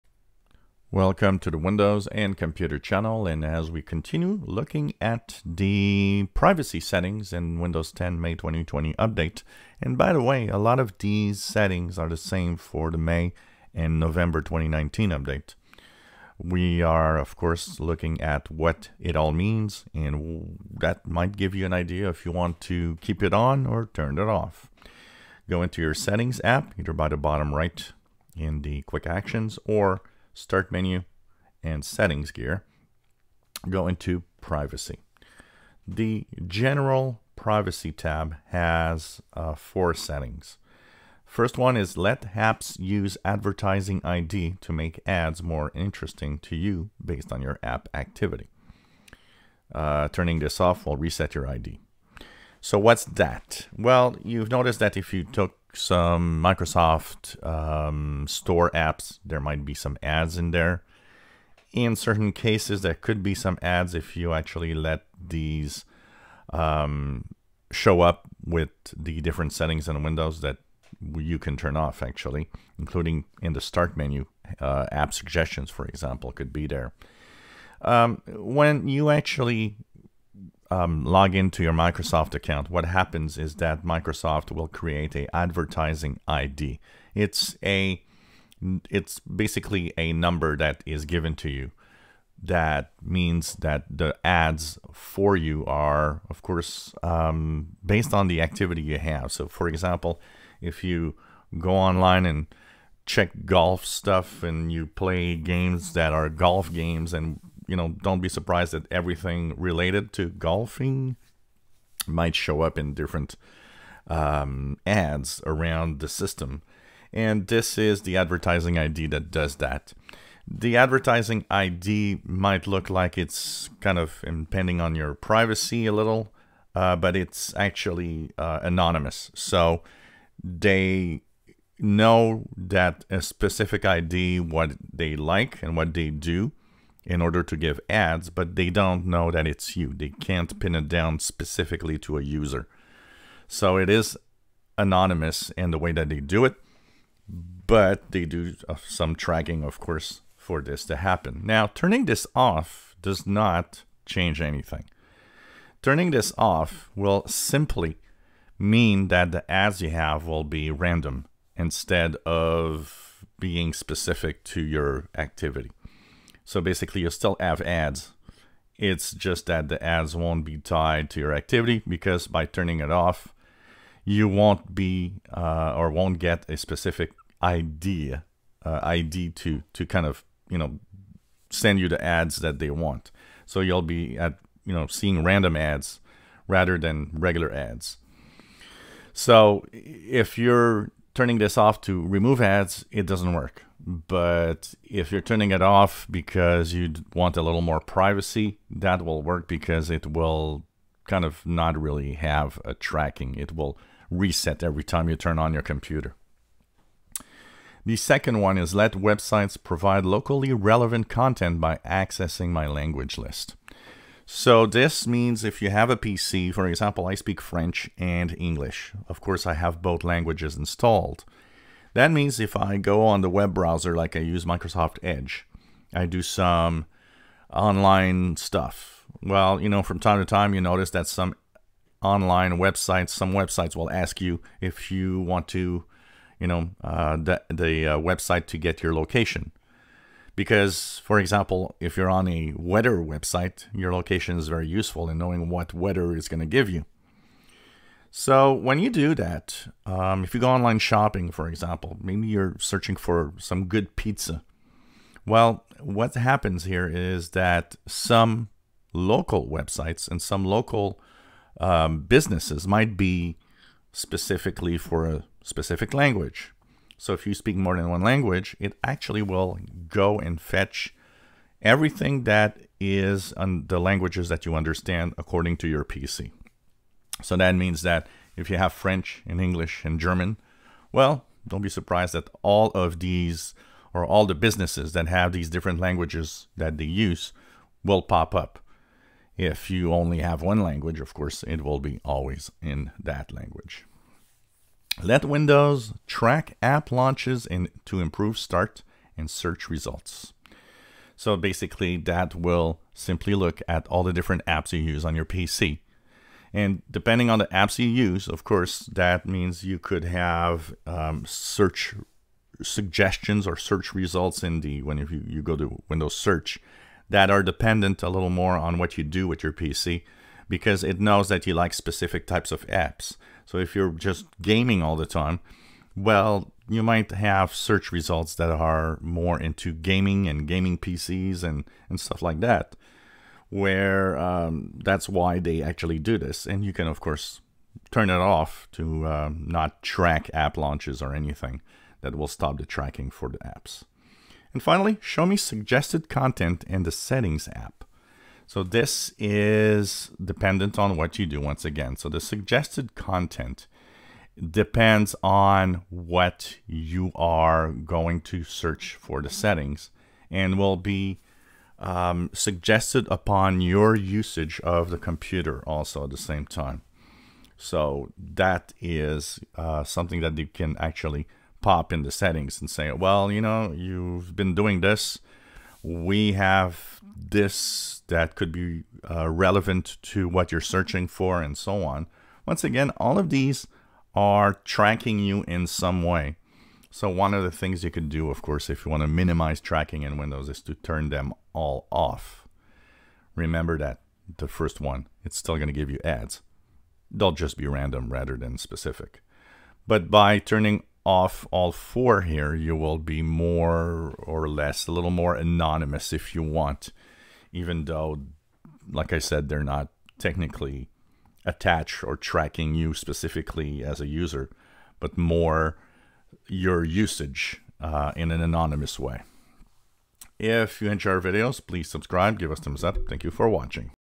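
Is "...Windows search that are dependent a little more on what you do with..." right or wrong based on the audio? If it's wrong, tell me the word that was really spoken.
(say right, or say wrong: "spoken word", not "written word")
right.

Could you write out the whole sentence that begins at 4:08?
So when you do that, um, if you go online shopping, for example, maybe you're searching for some good pizza.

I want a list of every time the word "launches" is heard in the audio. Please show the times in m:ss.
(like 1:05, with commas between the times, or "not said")
4:56, 5:40.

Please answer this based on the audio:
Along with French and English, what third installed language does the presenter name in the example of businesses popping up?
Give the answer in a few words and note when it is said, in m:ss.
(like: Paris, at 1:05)
German, at 4:39.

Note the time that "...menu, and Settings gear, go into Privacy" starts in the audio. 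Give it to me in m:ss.
0:30.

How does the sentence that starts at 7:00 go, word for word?
If you enjoy our videos, please subscribe, give us thumbs up.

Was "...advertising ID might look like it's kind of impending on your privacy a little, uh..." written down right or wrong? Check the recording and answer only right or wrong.
right.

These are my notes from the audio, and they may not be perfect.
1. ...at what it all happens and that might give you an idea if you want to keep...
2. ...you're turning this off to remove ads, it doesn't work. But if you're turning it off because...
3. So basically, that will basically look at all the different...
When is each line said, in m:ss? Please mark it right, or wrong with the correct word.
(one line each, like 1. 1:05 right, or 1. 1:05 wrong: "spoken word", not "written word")
1. 0:18 wrong: "means", not "happens"
2. 3:10 right
3. 5:01 wrong: "simply", not "basically".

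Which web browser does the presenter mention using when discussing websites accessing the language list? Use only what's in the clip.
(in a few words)
Microsoft Edge.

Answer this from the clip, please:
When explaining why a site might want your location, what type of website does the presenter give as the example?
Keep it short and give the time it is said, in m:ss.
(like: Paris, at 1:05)
Weather website, at 4:02.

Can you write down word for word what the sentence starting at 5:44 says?
And finally, show me suggested content in the settings app.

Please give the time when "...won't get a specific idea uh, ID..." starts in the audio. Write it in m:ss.
2:55.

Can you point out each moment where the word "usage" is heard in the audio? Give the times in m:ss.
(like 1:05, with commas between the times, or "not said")
6:03, 6:56.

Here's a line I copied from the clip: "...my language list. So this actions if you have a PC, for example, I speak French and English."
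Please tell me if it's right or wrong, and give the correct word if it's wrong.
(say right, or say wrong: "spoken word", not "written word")
wrong: "means", not "actions".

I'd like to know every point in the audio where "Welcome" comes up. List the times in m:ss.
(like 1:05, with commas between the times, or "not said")
0:00.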